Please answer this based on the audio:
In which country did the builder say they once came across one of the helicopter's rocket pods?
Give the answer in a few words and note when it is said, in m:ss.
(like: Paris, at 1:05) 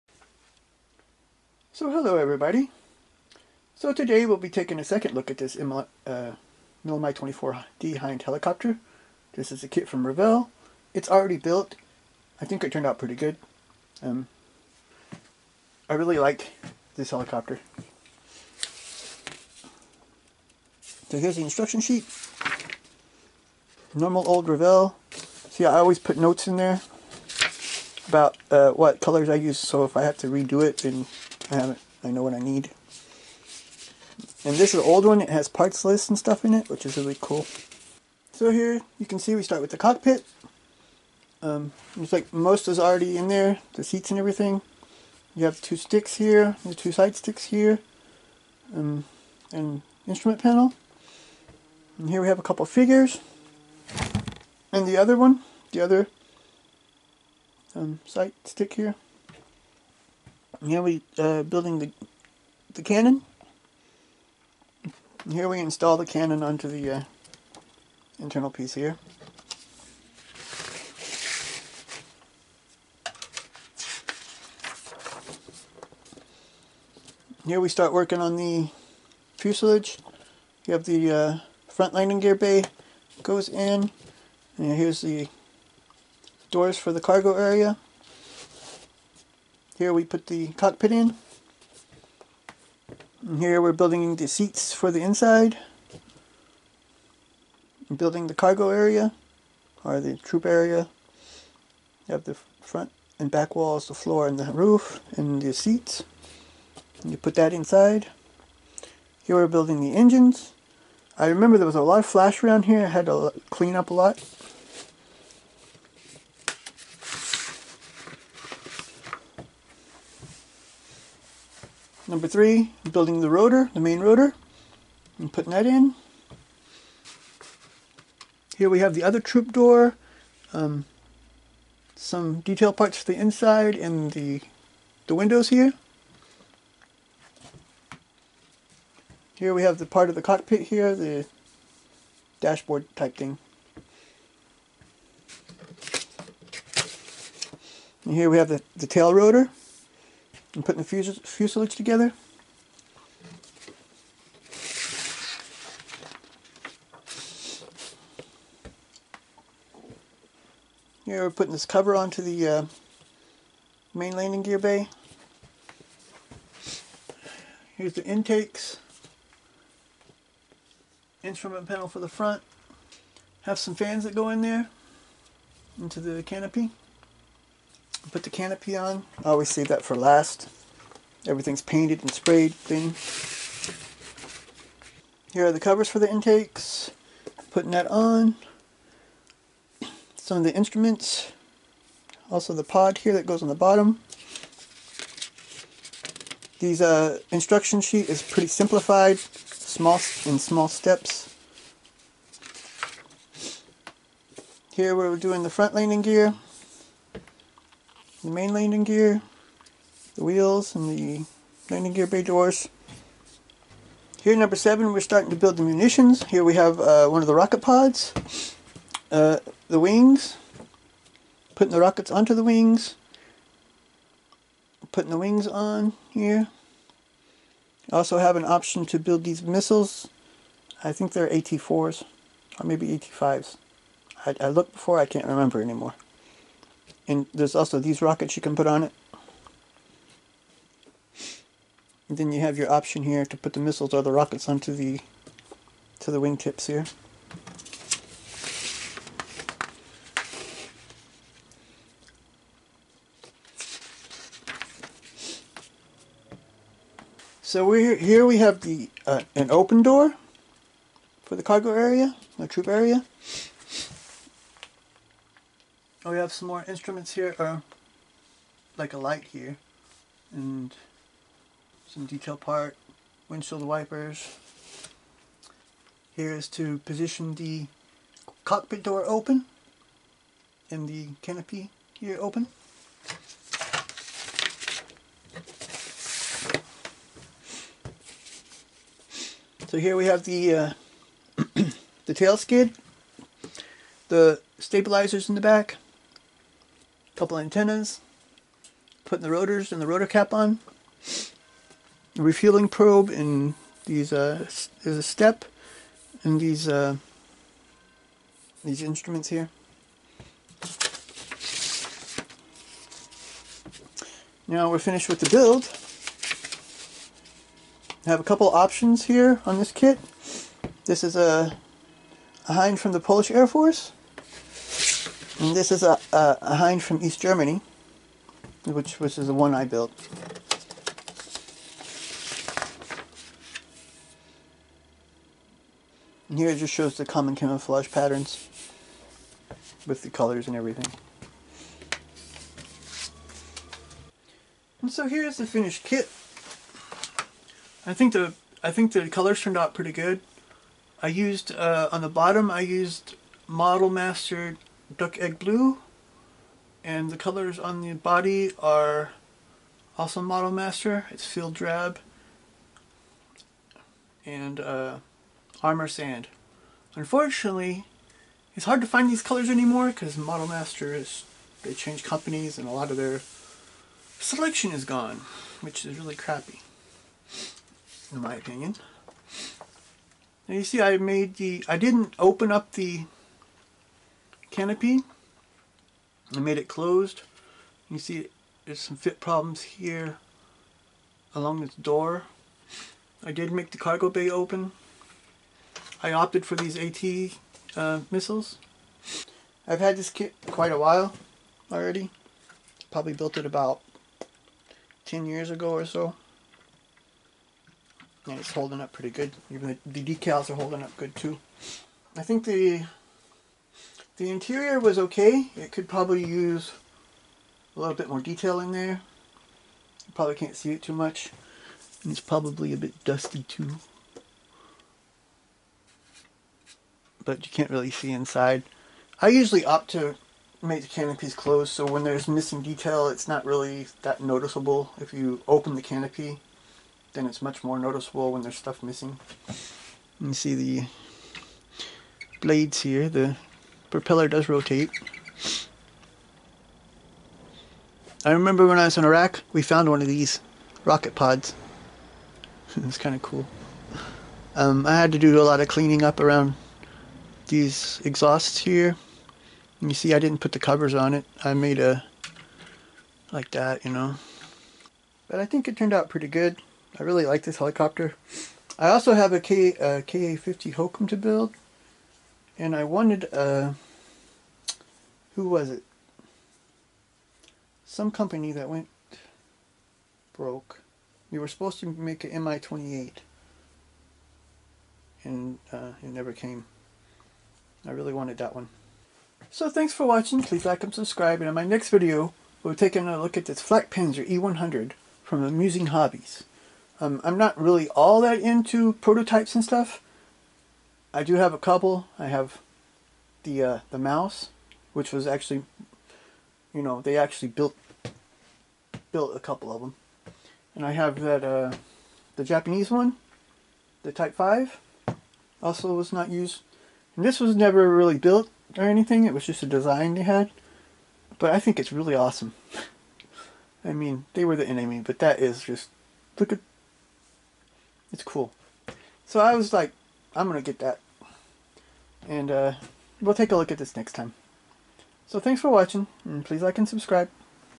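Iraq, at 7:29.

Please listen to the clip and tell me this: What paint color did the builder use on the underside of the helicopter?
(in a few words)
Duck egg blue.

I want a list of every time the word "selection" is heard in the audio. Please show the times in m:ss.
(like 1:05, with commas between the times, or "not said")
6:14.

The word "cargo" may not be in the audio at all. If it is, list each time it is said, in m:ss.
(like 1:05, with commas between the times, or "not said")
1:27, 1:38, 4:21, 6:33.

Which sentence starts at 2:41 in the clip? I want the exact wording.
Here we're putting this cover onto the uh, main landing gear bay.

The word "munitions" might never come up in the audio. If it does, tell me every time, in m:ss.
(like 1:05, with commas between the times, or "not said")
3:35.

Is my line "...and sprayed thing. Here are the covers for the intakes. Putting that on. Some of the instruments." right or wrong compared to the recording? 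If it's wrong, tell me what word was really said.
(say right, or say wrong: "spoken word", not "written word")
right.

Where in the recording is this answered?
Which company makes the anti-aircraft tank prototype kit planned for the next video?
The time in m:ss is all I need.
8:15.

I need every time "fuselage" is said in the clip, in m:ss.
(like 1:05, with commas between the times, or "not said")
1:19, 2:31.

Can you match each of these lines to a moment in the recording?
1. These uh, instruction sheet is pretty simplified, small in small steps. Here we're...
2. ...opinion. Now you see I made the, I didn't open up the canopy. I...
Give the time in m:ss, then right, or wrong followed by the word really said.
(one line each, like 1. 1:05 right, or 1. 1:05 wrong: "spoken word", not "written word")
1. 3:16 right
2. 6:18 right.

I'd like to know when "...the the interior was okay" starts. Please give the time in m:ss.
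6:52.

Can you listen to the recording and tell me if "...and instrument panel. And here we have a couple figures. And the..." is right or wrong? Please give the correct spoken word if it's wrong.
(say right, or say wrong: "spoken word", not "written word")
right.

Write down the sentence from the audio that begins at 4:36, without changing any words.
Here is to position the cockpit door open and the canopy here open.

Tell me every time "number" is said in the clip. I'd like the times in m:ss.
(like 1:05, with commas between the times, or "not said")
2:02, 3:34.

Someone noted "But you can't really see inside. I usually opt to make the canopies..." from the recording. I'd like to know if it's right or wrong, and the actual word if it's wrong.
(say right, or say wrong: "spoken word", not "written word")
right.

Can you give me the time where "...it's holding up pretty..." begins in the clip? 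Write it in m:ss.
6:48.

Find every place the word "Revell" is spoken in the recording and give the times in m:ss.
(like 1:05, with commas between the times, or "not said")
0:10, 0:24.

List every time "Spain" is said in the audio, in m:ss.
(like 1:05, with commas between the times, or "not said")
not said.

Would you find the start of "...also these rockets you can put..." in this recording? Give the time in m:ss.
3:57.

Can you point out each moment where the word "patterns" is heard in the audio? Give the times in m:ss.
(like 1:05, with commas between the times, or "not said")
5:37.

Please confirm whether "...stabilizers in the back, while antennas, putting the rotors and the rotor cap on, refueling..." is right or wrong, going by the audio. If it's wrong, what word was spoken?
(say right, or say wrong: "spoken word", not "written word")
wrong: "couple", not "while".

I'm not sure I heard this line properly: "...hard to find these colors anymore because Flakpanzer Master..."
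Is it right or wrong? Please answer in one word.
wrong.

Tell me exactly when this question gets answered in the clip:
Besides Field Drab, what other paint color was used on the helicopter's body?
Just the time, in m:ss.
6:05.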